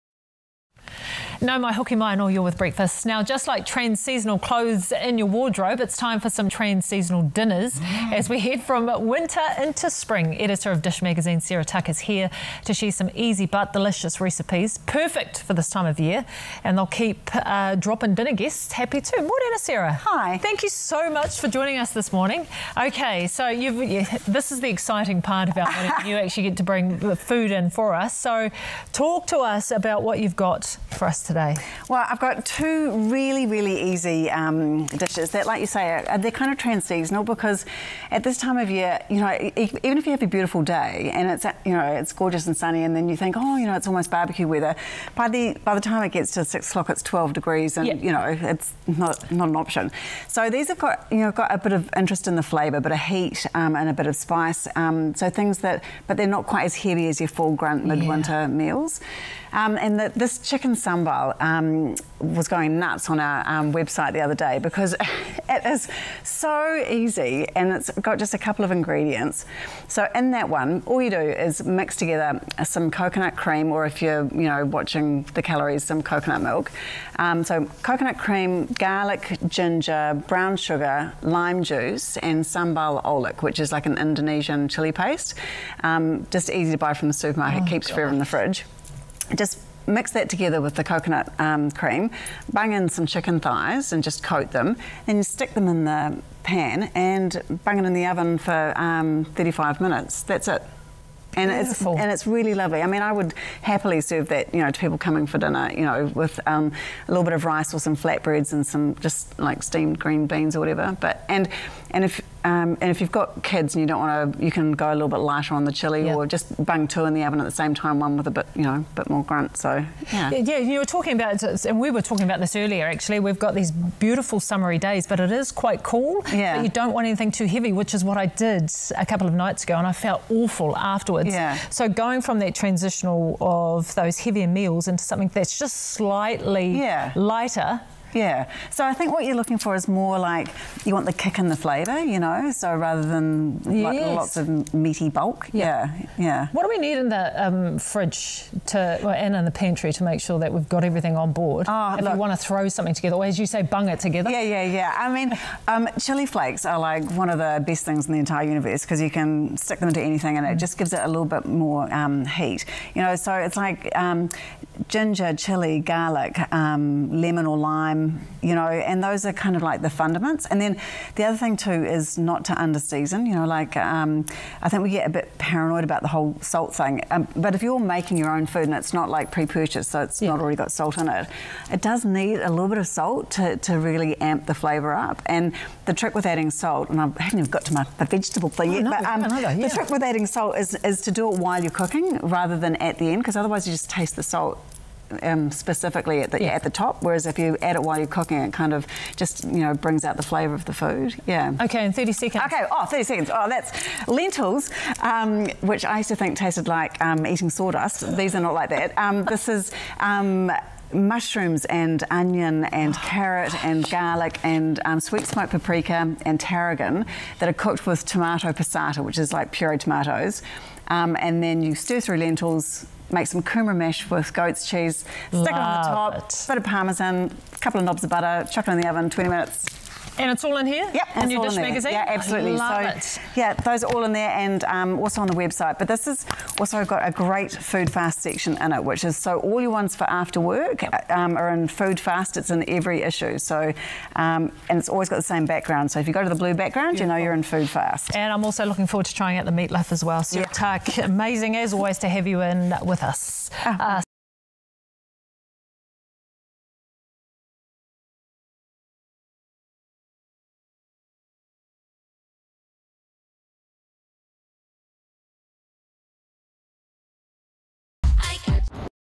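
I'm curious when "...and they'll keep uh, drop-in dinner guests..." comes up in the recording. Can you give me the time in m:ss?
0:16.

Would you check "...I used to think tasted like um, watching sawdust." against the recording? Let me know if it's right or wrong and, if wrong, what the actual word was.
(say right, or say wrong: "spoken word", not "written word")
wrong: "eating", not "watching".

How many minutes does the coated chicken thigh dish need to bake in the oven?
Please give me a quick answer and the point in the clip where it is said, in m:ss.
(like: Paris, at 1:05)
35, at 1:39.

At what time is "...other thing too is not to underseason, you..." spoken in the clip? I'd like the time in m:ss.
2:51.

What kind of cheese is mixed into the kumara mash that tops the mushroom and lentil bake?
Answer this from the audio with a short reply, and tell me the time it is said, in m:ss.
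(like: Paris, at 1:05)
goat's cheese, at 3:44.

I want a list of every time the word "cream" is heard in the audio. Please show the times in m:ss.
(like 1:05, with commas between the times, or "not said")
1:13, 1:18, 1:31.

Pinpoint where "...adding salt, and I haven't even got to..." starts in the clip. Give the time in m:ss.
3:06.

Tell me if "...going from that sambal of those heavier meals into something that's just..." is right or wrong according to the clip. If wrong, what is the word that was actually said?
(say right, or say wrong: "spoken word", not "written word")
wrong: "transitional", not "sambal".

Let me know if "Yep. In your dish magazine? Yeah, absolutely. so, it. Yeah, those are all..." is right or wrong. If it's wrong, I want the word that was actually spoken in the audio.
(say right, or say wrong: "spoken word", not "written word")
right.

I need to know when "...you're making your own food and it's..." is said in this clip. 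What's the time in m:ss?
2:57.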